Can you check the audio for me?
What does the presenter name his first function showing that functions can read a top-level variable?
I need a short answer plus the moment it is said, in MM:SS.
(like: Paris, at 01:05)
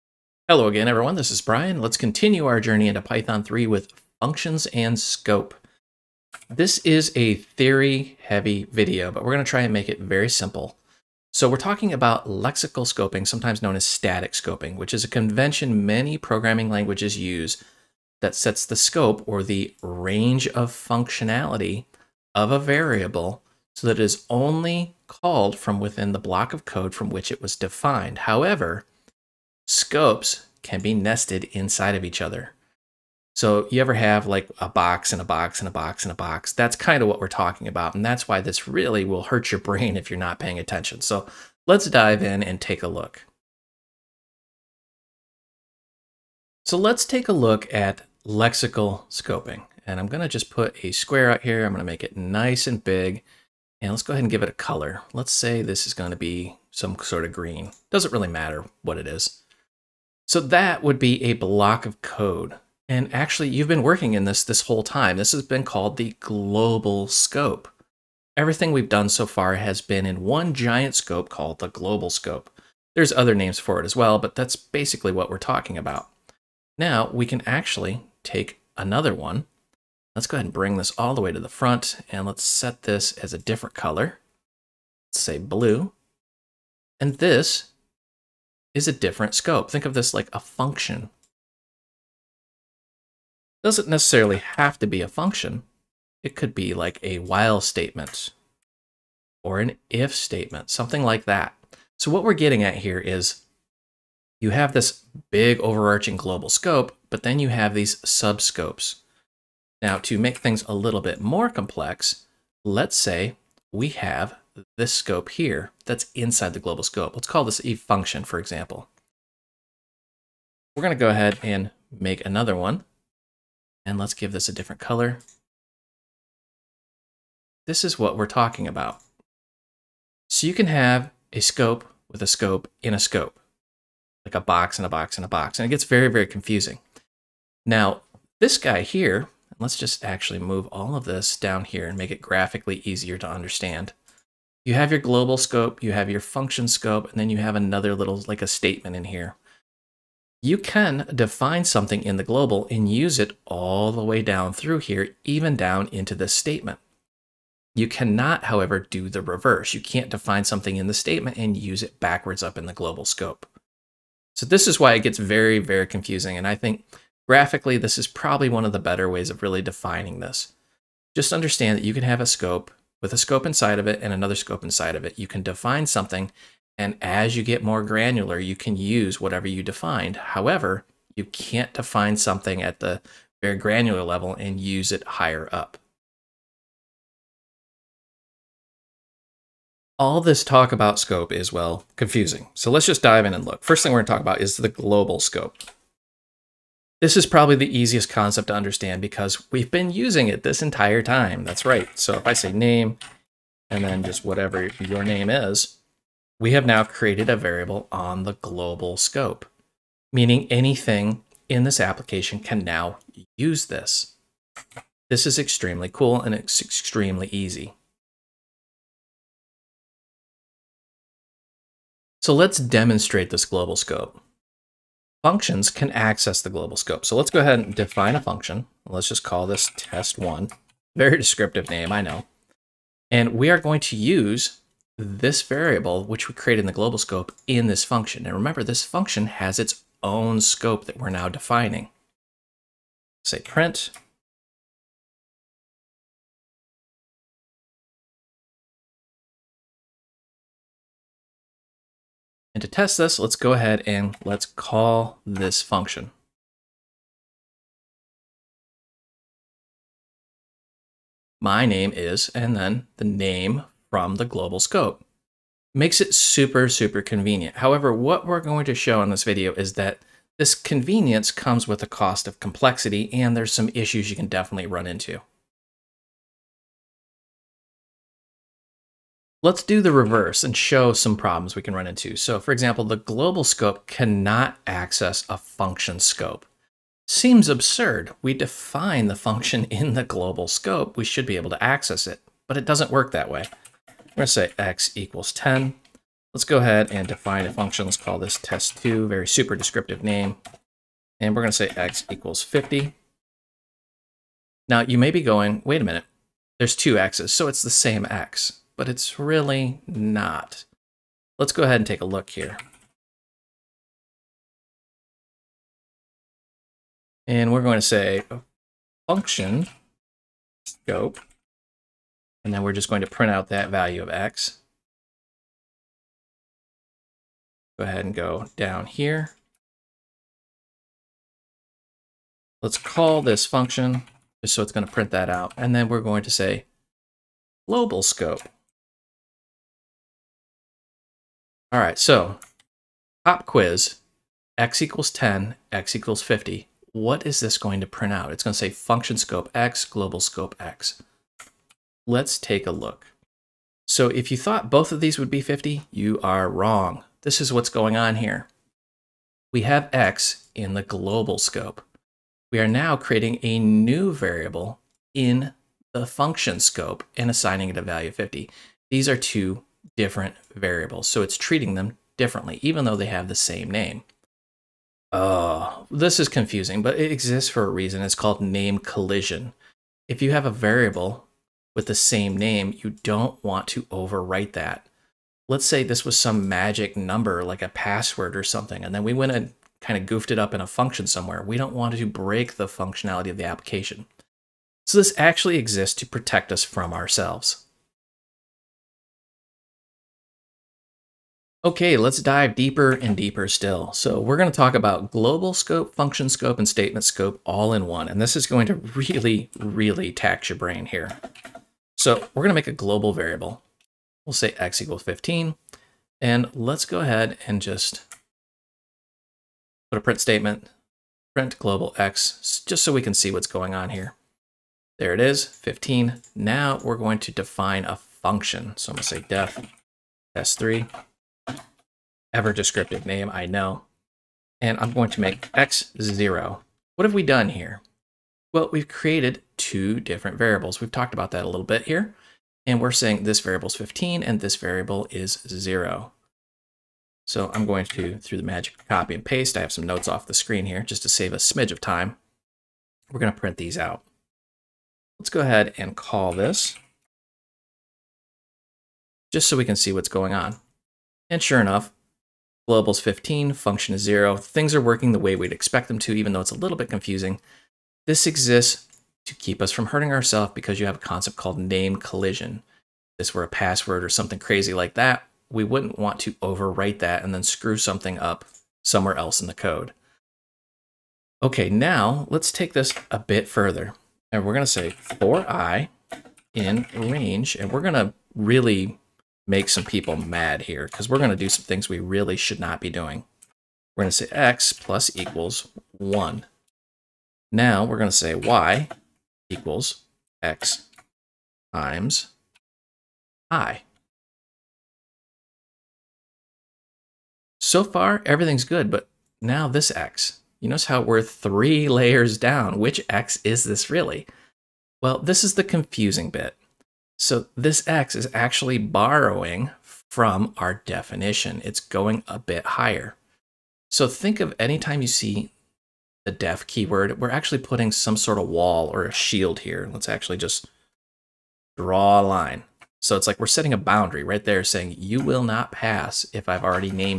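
test one, at 03:49.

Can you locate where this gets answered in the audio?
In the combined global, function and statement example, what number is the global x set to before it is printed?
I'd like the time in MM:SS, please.
06:54.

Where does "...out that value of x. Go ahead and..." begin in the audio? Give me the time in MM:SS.
05:23.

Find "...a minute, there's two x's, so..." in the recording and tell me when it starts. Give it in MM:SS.
05:05.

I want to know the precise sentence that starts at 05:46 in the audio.
What is this going to print out?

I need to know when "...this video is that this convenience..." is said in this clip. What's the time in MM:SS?
04:29.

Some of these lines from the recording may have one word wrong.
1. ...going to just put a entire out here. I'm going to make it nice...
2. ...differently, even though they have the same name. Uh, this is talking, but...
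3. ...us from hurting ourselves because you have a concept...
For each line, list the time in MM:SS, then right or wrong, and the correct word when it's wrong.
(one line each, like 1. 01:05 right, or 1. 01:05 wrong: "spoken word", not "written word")
1. 00:50 wrong: "square", not "entire"
2. 06:12 wrong: "confusing", not "talking"
3. 07:49 right.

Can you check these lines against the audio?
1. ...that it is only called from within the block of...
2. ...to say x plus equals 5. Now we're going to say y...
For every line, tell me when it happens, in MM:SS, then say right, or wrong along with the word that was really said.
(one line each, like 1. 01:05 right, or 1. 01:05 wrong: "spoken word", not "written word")
1. 00:23 right
2. 08:14 wrong: "1", not "5".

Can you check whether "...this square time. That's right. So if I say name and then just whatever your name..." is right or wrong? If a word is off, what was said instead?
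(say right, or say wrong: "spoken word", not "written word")
wrong: "entire", not "square".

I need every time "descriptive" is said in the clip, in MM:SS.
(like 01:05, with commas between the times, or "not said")
03:51, 04:59, 07:12.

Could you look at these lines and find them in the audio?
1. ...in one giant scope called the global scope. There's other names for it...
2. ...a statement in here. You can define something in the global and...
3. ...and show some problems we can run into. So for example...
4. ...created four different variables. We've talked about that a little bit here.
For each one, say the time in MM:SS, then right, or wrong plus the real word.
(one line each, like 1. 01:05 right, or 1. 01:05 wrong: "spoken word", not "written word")
1. 01:10 right
2. 02:28 right
3. 04:40 right
4. 07:18 wrong: "two", not "four".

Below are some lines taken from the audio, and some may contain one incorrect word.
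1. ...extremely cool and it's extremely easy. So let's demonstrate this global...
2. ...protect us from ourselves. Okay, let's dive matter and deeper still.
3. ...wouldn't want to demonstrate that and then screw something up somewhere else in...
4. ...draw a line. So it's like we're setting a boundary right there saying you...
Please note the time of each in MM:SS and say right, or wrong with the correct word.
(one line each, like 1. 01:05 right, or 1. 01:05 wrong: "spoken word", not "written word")
1. 03:35 right
2. 06:36 wrong: "deeper", not "matter"
3. 07:55 wrong: "overwrite", not "demonstrate"
4. 08:51 right.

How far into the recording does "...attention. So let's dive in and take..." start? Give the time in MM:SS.
00:40.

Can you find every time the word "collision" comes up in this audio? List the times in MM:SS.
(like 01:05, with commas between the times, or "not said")
06:18, 07:51.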